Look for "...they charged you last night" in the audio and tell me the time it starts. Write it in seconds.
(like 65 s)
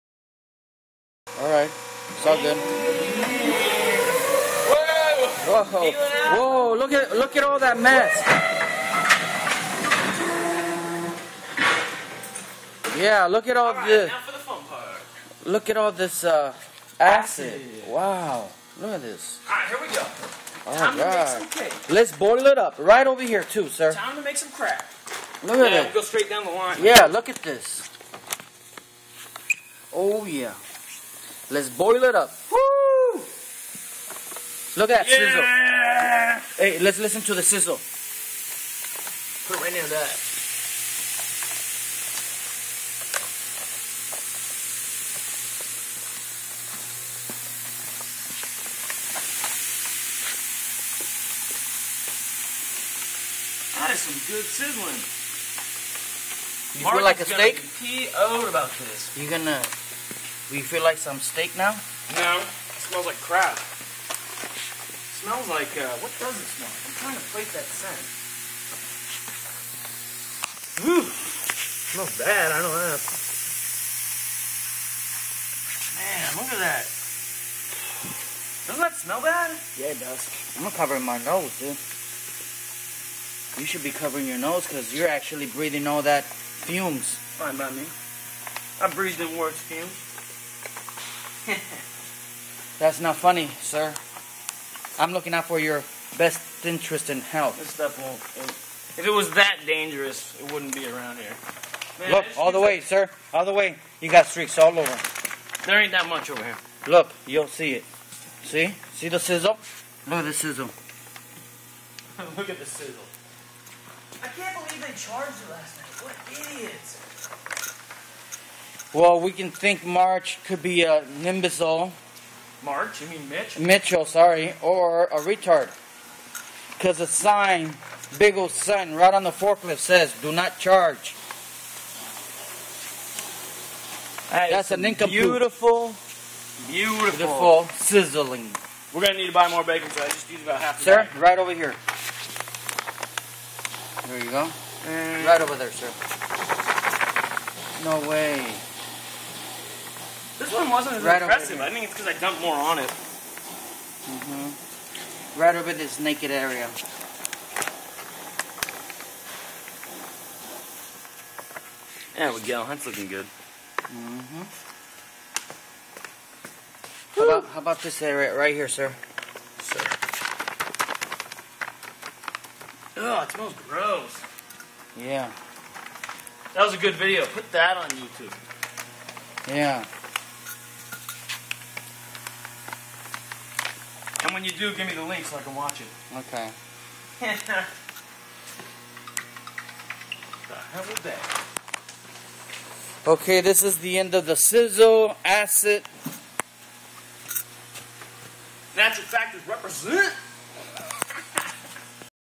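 114 s.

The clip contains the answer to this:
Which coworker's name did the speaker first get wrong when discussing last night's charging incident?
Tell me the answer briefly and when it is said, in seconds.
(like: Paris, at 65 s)
Mitch, at 123 s.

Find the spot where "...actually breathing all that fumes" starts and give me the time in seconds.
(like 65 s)
85 s.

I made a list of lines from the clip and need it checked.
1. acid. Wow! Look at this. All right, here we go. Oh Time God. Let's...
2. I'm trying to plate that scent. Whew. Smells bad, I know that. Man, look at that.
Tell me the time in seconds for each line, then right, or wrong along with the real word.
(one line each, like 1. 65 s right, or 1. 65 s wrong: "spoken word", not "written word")
1. 17 s right
2. 66 s right.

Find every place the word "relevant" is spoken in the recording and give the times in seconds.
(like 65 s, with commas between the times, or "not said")
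not said.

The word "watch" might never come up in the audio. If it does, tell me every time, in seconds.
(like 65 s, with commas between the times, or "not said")
185 s.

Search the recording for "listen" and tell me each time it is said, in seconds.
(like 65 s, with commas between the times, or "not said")
36 s.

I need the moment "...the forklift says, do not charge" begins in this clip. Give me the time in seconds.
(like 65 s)
129 s.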